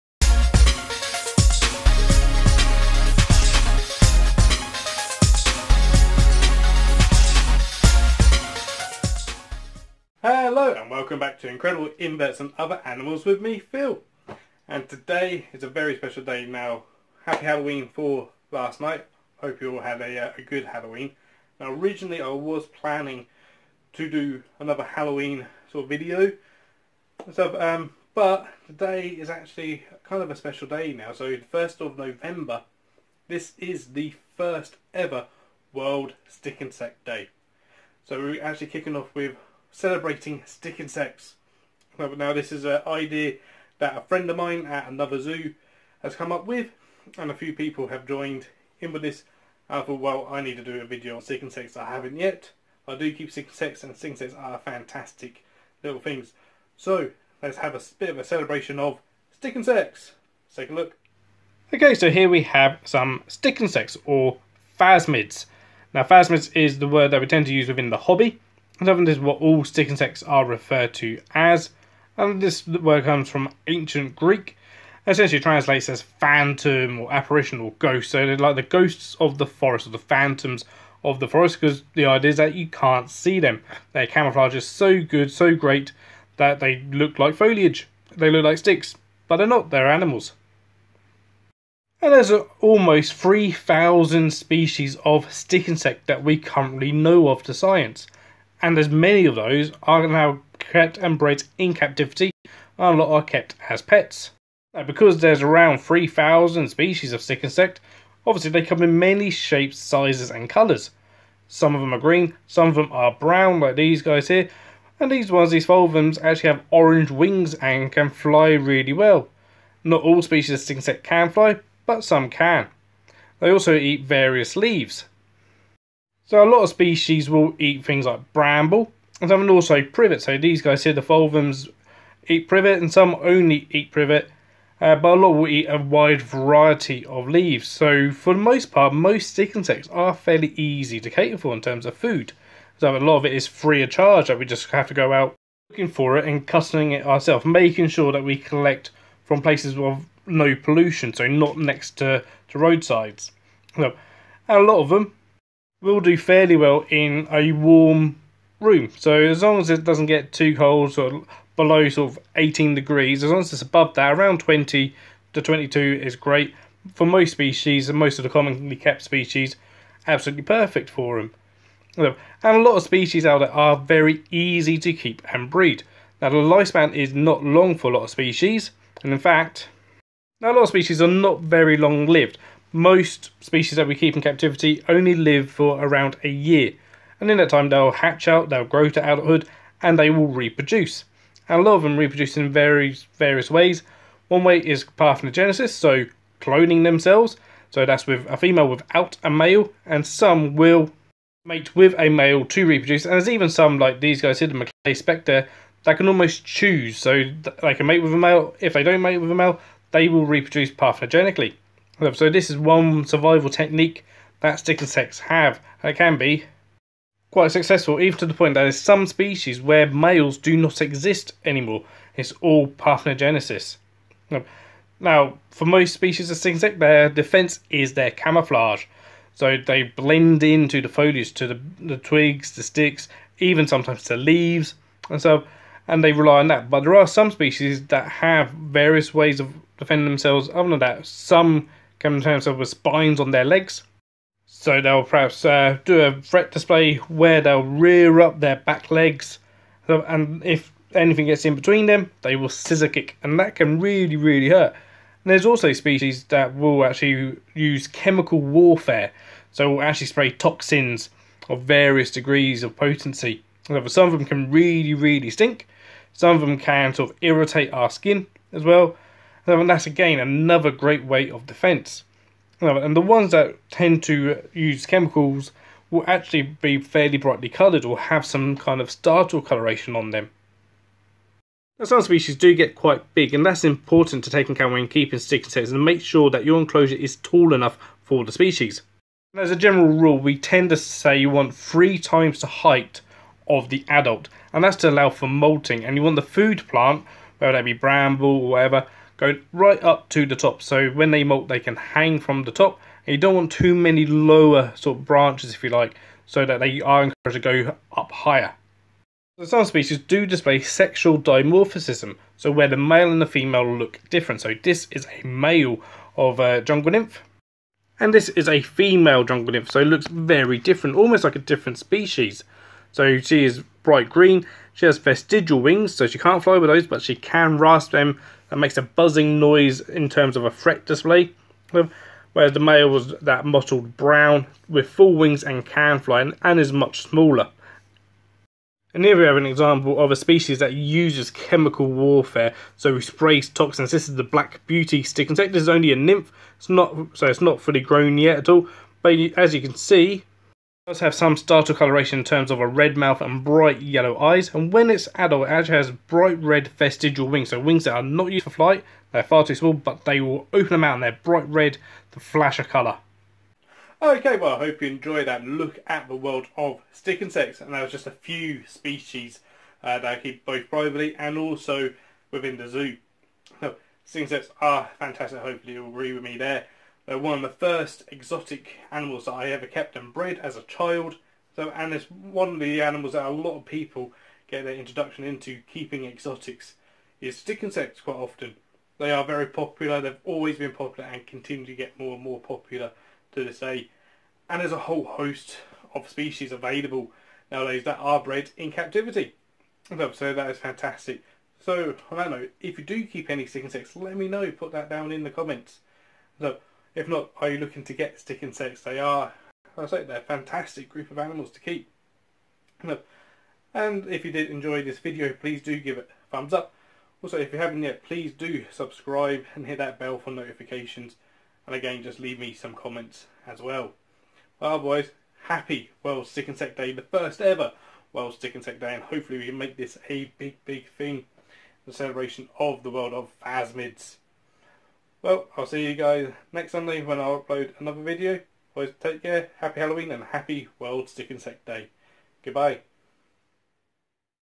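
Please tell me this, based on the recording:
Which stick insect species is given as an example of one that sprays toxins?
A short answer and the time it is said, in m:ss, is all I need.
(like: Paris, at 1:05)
Black beauty stick insect, at 5:44.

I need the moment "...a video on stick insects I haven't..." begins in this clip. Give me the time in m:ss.
0:50.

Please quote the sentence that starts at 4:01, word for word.
Some in to terms with spines on their legs.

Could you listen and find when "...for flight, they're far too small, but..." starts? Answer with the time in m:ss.
5:58.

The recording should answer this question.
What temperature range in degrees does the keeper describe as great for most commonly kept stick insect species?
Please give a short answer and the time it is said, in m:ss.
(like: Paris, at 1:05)
20 to 22, at 2:44.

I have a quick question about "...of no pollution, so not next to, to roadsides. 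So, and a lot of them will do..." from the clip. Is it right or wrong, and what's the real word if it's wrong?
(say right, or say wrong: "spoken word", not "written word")
right.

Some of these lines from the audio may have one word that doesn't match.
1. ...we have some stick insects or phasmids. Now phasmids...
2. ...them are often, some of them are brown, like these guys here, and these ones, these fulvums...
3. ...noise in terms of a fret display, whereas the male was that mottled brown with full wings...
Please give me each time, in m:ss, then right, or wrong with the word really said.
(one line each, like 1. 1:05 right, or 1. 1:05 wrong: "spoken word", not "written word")
1. 1:02 right
2. 1:51 wrong: "green", not "often"
3. 5:29 right.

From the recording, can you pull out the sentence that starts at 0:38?
So we're actually kicking off with celebrating stick insects.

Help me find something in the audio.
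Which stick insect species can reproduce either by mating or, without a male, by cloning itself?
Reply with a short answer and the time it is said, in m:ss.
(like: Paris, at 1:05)
Macleay Spectre, at 3:24.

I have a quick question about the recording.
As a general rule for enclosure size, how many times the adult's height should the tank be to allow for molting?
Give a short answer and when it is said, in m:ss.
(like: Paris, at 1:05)
3, at 4:51.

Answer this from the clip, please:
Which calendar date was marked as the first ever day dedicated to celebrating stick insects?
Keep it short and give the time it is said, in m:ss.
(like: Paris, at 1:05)
1st of November, at 0:31.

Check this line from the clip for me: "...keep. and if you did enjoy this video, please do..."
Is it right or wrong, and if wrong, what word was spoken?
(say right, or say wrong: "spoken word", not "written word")
right.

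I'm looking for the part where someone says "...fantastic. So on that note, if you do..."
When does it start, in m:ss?
6:40.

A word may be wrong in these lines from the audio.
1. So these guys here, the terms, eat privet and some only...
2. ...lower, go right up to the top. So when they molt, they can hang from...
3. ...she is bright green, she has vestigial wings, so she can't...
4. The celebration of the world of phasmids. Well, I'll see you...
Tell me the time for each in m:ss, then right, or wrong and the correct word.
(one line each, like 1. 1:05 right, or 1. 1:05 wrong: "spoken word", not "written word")
1. 2:10 wrong: "fulvums", not "terms"
2. 4:58 wrong: "whatever", not "lower"
3. 5:23 right
4. 7:11 right.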